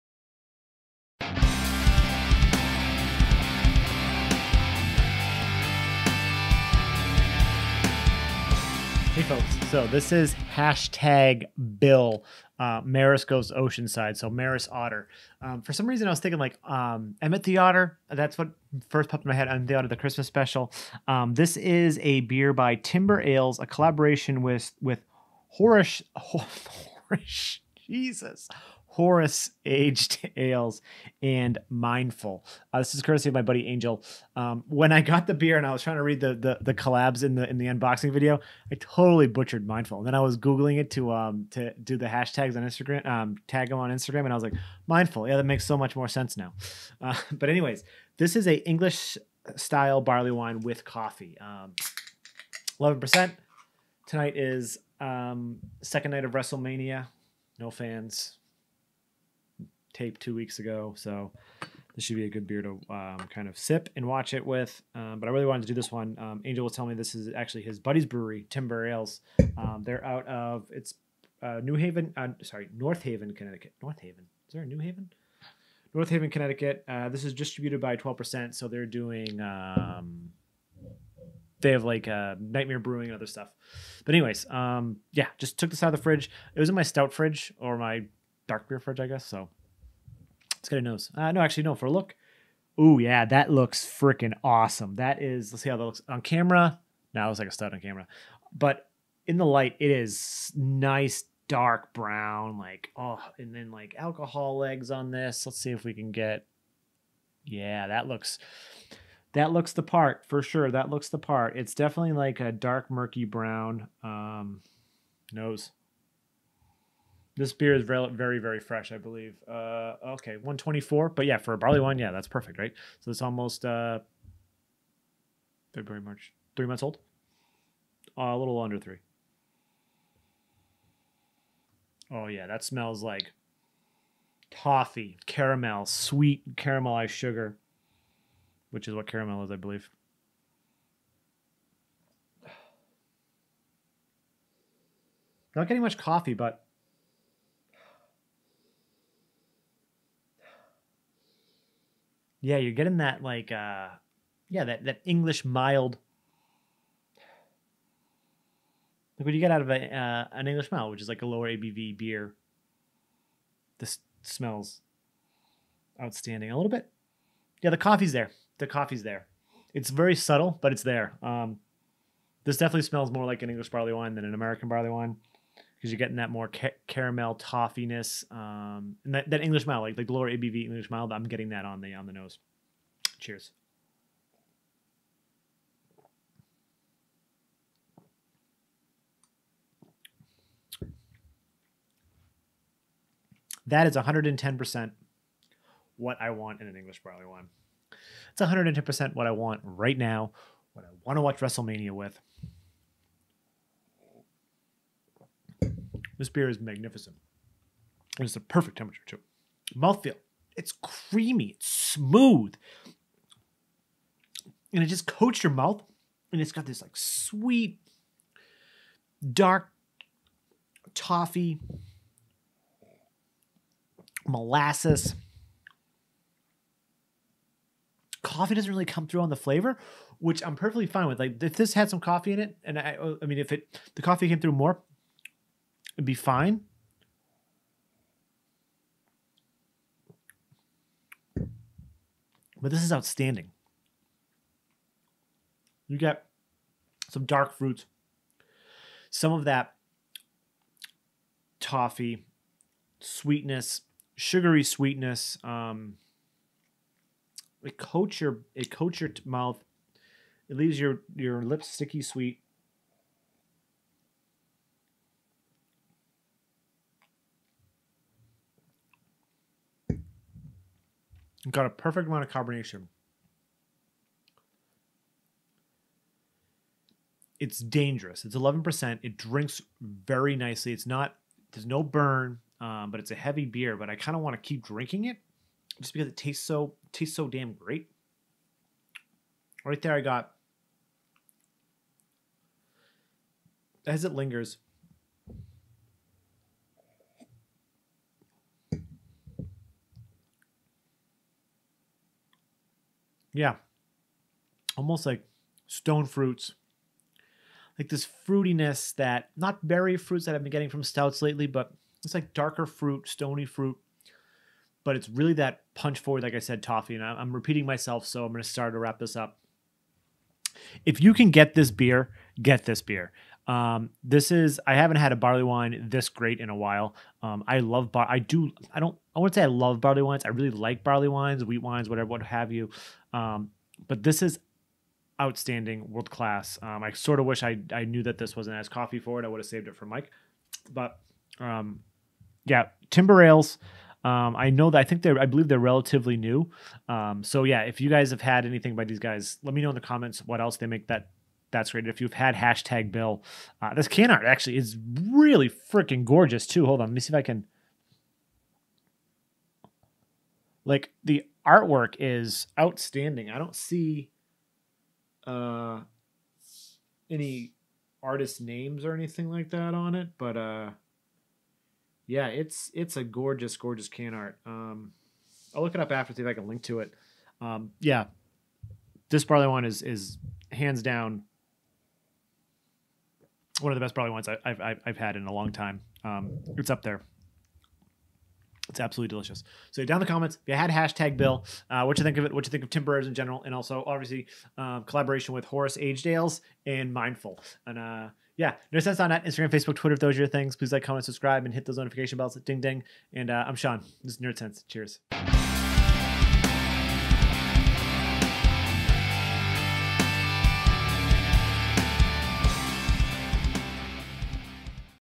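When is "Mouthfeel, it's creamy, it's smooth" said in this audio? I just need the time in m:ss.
3:29.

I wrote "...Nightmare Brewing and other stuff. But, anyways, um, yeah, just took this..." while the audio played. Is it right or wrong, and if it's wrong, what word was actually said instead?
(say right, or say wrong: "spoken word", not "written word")
right.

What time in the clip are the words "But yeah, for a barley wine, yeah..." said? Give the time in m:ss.
2:01.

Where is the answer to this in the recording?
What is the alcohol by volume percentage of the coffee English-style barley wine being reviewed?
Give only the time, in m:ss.
0:52.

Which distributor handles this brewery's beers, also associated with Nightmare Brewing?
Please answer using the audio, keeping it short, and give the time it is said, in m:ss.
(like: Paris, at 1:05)
12%, at 1:17.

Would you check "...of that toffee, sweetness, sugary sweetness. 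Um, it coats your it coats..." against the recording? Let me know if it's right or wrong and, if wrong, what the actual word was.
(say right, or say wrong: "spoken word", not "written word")
right.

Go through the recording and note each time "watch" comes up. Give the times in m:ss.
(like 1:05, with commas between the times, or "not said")
1:04, 3:21.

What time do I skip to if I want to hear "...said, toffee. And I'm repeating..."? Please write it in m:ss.
5:16.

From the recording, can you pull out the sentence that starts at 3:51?
Like if this had some coffee in it, and I, I mean, if it the coffee came through more, It'd be fine.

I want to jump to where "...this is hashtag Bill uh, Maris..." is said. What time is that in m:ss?
0:09.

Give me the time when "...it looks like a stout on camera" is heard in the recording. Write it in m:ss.
1:37.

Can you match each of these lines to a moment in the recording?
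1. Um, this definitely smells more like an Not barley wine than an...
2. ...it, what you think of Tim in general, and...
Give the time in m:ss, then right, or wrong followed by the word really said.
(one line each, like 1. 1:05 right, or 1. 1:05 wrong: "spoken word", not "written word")
1. 2:51 wrong: "English", not "Not"
2. 6:32 right.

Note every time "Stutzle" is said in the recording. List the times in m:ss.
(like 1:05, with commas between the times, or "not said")
not said.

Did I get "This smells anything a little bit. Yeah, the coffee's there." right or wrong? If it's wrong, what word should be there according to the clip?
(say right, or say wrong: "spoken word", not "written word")
wrong: "outstanding", not "anything".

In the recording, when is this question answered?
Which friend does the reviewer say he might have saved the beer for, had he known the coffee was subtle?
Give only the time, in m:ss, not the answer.
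5:39.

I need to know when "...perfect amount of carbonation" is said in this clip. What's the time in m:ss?
4:31.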